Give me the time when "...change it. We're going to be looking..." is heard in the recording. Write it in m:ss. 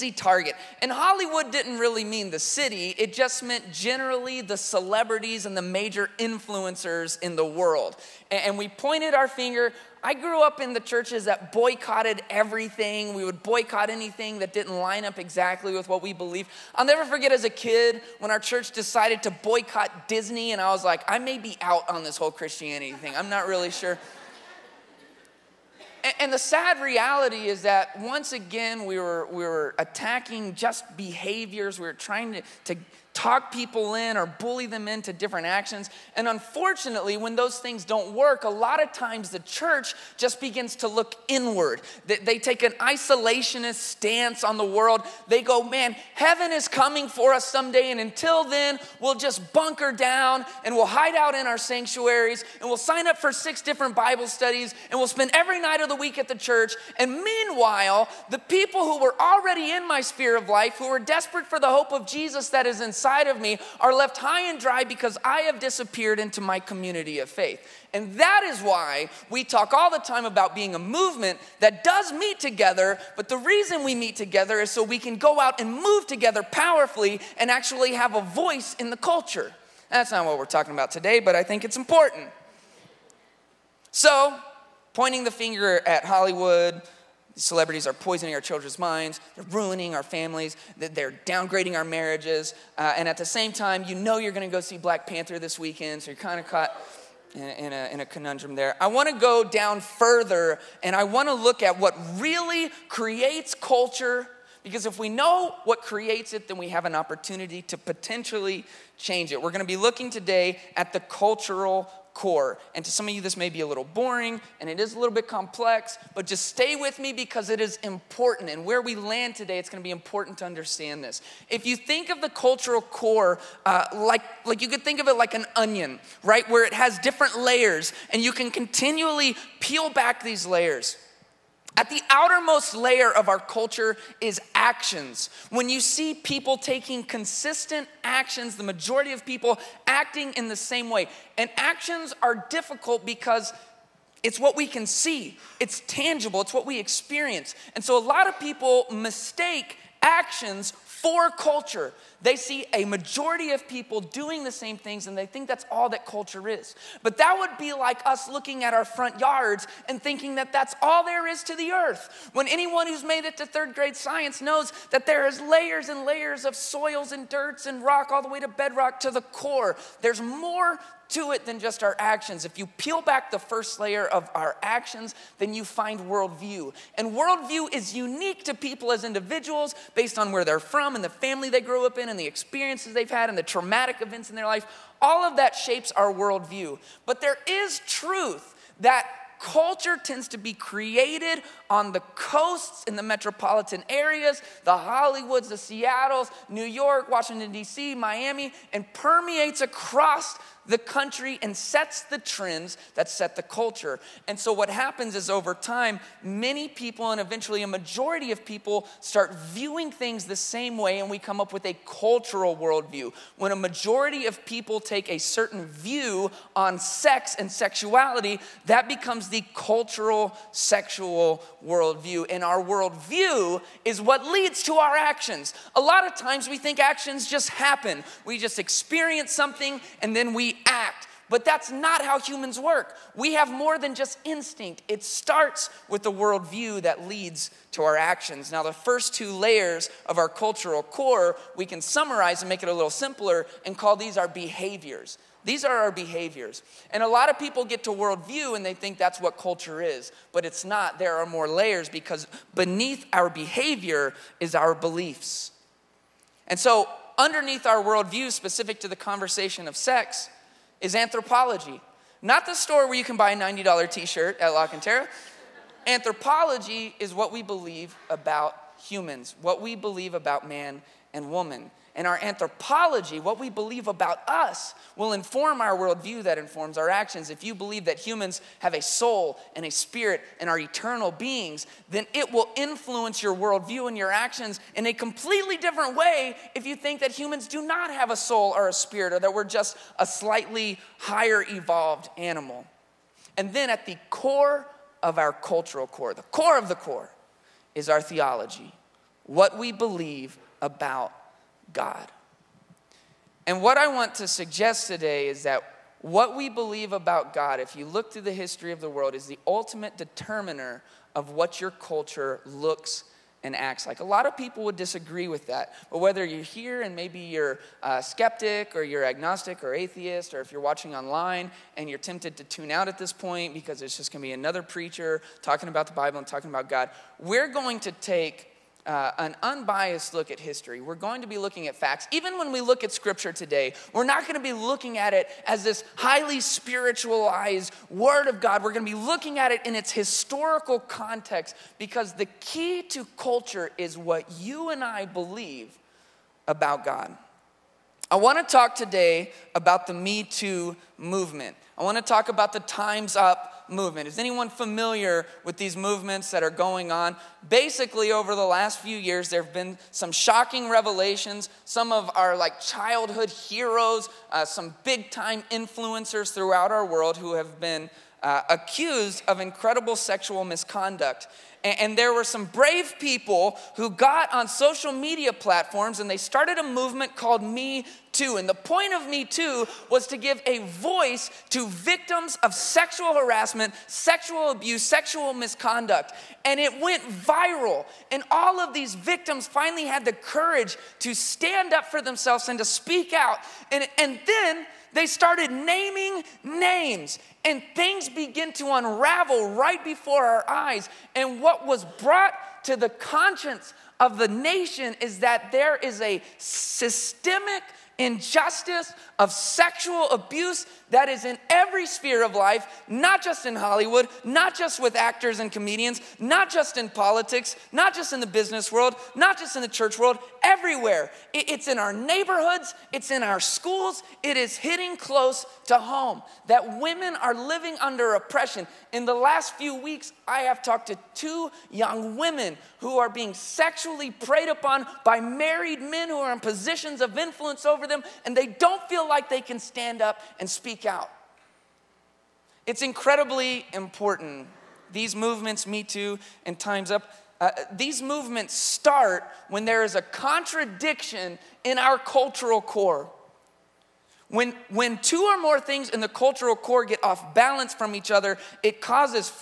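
1:48.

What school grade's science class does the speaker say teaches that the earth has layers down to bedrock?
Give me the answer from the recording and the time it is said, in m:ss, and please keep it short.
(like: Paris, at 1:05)
Third grade, at 2:43.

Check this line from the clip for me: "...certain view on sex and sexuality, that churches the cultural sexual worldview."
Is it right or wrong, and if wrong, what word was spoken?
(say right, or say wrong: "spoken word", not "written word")
wrong: "becomes", not "churches".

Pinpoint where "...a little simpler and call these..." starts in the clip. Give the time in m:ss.
4:02.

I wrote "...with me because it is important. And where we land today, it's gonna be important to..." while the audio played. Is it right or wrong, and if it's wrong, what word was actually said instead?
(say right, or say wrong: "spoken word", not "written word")
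right.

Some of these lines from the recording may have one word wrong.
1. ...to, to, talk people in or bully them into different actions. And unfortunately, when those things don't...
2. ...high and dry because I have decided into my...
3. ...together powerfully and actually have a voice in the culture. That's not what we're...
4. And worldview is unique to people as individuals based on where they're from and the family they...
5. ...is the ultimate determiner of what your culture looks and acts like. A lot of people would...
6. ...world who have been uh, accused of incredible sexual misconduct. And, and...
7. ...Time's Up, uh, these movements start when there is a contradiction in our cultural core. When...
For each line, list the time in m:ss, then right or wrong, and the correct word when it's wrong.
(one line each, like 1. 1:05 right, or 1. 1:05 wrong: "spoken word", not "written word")
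1. 0:32 right
2. 1:04 wrong: "disappeared", not "decided"
3. 1:16 right
4. 2:56 right
5. 5:09 right
6. 6:06 right
7. 7:26 right.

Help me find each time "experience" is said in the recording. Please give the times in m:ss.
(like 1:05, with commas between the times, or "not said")
2:26, 3:02, 3:48.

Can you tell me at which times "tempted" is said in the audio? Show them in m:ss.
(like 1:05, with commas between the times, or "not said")
5:21.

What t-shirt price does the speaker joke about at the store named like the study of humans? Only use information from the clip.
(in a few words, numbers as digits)
$90.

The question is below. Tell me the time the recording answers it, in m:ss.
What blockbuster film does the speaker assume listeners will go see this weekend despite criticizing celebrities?
1:34.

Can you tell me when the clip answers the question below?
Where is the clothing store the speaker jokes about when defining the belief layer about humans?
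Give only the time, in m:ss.
4:24.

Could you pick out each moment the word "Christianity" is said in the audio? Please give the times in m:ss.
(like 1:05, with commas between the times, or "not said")
0:22.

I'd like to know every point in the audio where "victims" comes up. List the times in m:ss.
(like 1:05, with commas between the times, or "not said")
6:21, 6:28.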